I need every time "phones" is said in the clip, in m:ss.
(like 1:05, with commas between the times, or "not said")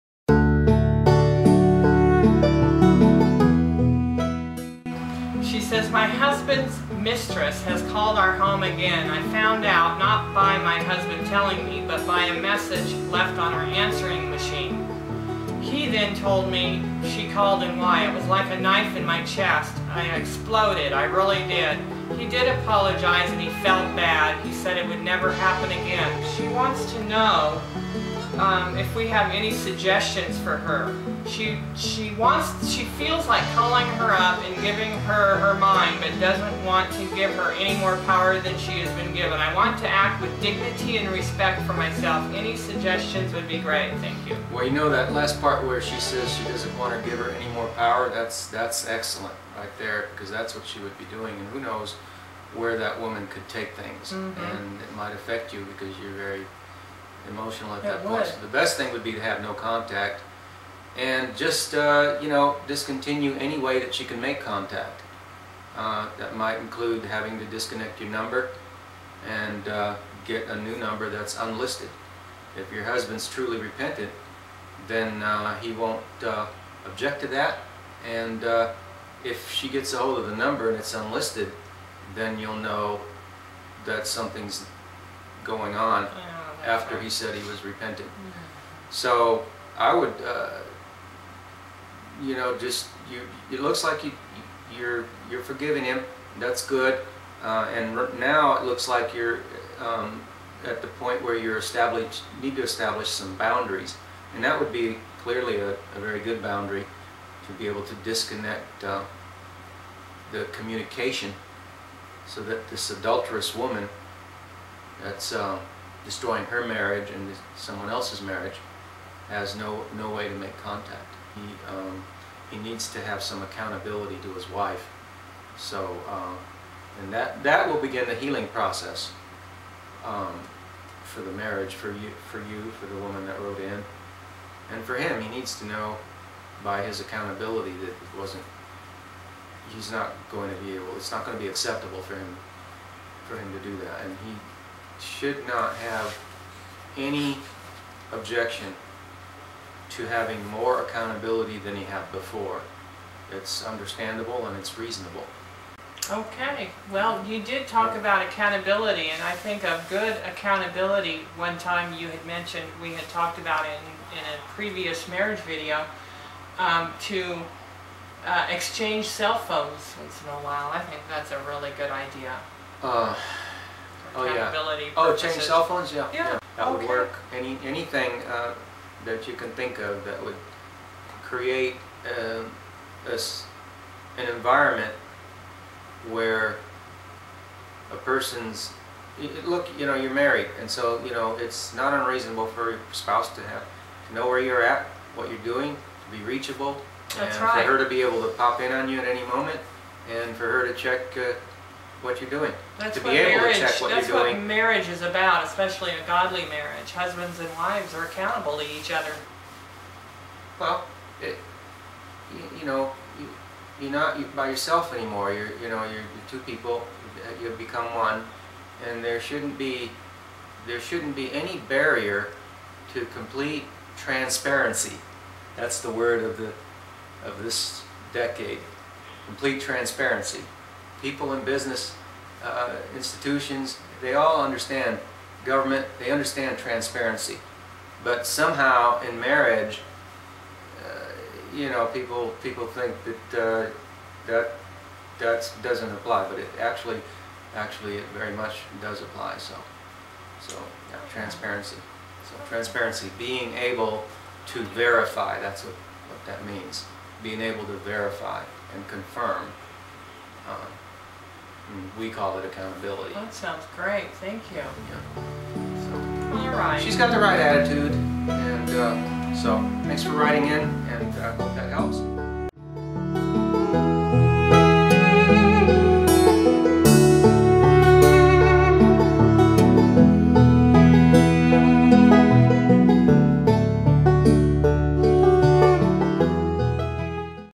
2:49, 2:55.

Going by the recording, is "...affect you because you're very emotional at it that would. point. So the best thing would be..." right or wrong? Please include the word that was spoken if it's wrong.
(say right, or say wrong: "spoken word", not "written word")
right.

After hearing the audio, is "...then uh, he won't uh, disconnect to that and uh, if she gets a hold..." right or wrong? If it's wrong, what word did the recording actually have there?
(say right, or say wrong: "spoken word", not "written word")
wrong: "object", not "disconnect".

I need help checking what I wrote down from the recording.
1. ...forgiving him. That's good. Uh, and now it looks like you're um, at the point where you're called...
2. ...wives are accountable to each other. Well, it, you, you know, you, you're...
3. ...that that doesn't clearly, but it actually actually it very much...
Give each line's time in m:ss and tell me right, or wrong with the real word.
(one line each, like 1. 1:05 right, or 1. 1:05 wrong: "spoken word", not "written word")
1. 1:35 wrong: "established", not "called"
2. 3:27 right
3. 4:04 wrong: "apply", not "clearly".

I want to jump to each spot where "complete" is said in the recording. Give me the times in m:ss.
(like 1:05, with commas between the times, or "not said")
3:43, 3:49.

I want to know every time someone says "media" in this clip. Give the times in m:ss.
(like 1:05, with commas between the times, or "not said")
not said.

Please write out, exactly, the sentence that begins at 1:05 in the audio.
Uh, that might include having to disconnect your number and uh, get a new number that's unlisted.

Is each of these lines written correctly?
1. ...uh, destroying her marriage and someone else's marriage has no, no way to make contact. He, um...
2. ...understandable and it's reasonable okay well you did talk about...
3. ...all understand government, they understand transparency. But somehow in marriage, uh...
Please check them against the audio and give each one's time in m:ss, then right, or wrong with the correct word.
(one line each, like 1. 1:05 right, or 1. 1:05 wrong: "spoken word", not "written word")
1. 1:55 right
2. 2:33 right
3. 3:54 right.